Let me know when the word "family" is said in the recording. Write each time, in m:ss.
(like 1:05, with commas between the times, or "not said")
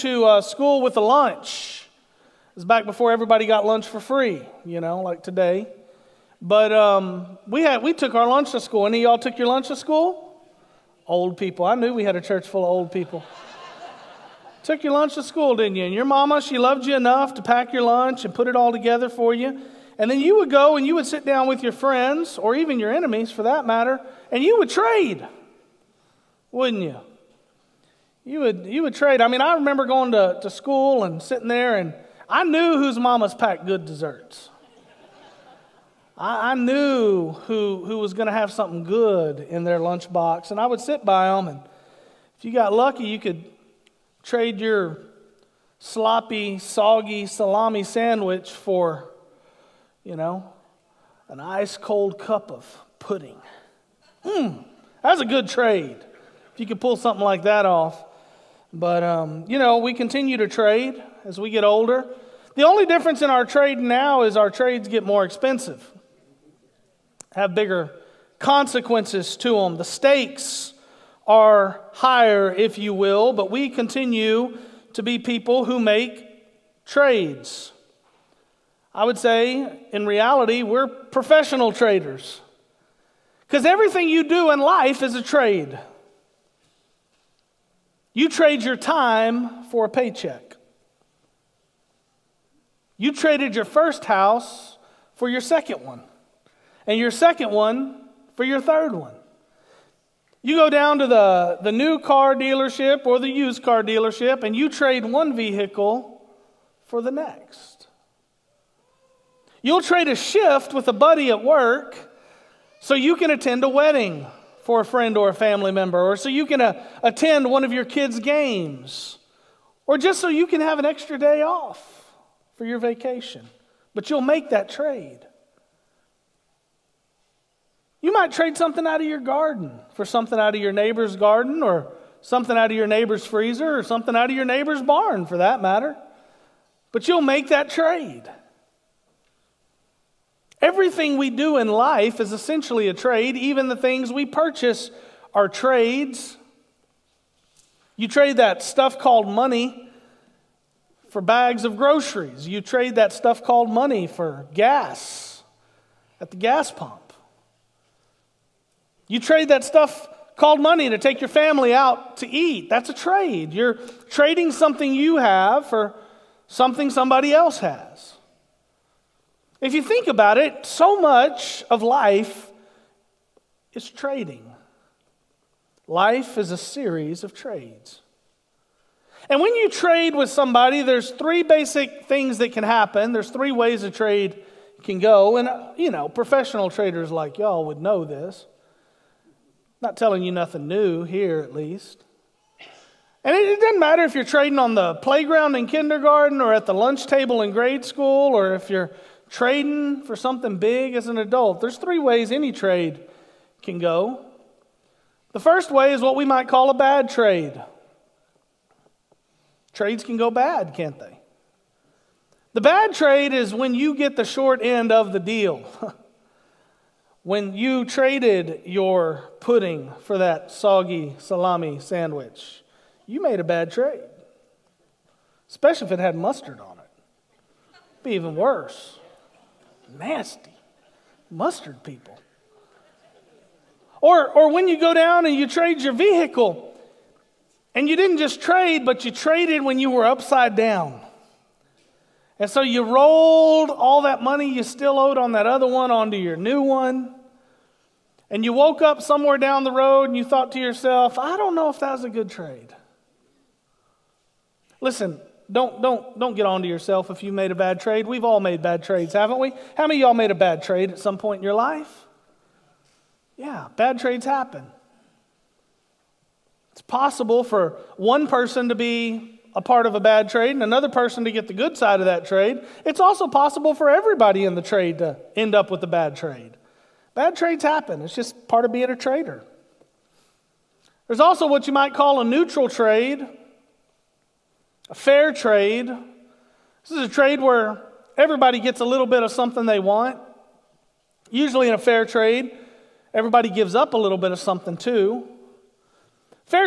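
1:55, 2:41.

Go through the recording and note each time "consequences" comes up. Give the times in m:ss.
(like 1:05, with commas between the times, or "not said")
1:08.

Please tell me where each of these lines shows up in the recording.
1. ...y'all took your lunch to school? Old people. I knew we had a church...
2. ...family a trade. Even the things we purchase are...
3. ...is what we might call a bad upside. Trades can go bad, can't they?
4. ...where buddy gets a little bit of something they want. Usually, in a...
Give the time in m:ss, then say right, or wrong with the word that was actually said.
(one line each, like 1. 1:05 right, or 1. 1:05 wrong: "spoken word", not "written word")
1. 0:09 right
2. 2:22 wrong: "essentially", not "family"
3. 3:25 wrong: "trade", not "upside"
4. 4:47 wrong: "everybody", not "buddy".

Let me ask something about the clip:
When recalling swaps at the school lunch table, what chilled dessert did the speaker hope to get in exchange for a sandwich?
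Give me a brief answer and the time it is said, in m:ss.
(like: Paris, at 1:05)
Cup of pudding, at 0:52.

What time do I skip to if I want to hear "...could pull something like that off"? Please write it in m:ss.
0:56.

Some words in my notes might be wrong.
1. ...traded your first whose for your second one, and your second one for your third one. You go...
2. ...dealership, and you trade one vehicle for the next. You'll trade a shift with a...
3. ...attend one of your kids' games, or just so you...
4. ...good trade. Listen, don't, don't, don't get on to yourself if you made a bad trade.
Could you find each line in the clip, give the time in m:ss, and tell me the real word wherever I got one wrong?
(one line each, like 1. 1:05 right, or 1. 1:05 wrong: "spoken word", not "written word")
1. 1:33 wrong: "house", not "whose"
2. 1:43 right
3. 1:57 right
4. 4:12 right.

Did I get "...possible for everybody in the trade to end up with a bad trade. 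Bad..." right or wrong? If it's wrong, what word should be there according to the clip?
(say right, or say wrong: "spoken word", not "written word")
right.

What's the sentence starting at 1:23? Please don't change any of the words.
Because everything you do in life is a trade.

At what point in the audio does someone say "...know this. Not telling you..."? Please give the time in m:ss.
3:07.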